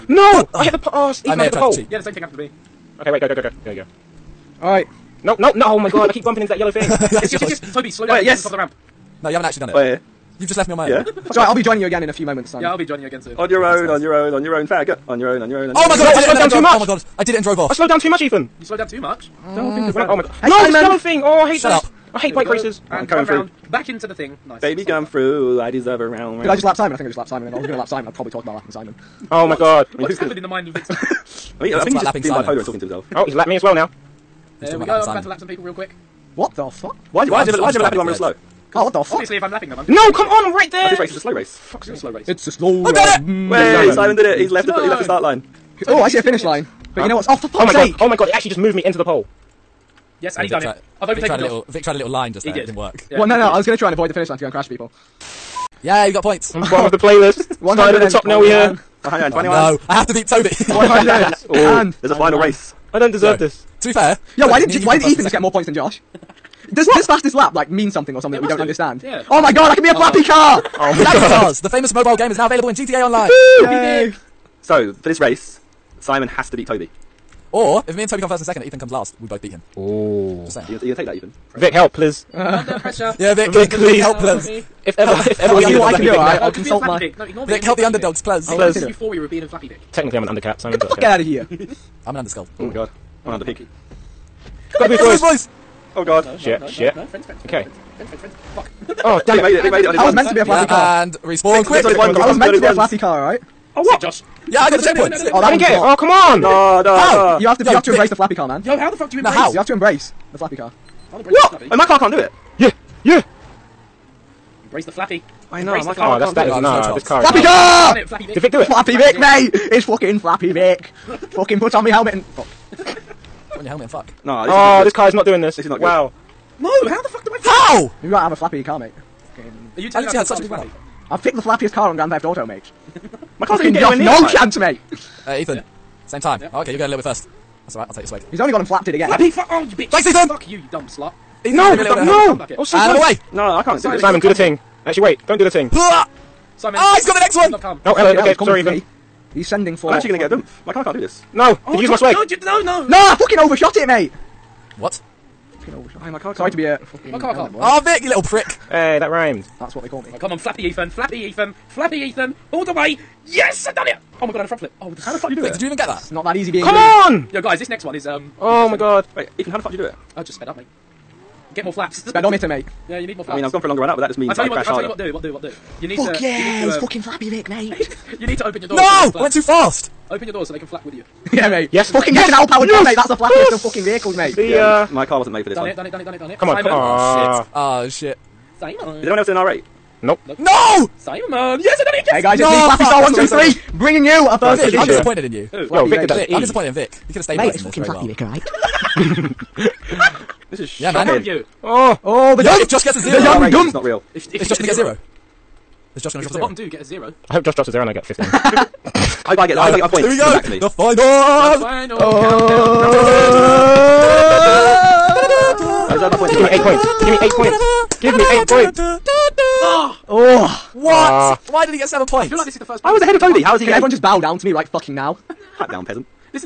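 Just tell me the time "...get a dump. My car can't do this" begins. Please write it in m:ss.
2:30.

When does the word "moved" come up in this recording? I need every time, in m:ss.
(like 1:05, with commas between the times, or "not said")
0:48.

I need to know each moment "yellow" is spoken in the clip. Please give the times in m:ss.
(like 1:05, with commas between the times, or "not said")
0:06, 0:20.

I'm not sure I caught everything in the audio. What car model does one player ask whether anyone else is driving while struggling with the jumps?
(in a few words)
R8.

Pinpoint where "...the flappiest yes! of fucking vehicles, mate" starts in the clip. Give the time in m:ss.
3:03.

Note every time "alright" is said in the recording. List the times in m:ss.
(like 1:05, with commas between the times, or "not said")
0:04, 0:11, 2:17, 3:18.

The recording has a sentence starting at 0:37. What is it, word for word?
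Why did Yeah, why did you ever why did you ever lap anyone real edge.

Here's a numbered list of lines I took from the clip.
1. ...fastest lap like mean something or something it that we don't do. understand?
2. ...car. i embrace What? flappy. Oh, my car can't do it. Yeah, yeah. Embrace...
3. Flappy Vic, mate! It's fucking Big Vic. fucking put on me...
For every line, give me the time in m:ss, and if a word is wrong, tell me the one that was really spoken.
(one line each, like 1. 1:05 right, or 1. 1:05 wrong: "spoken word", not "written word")
1. 1:07 right
2. 1:50 right
3. 1:58 wrong: "Flappy", not "Big".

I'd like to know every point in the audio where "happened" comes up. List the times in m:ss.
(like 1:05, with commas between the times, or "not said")
0:02, 0:30.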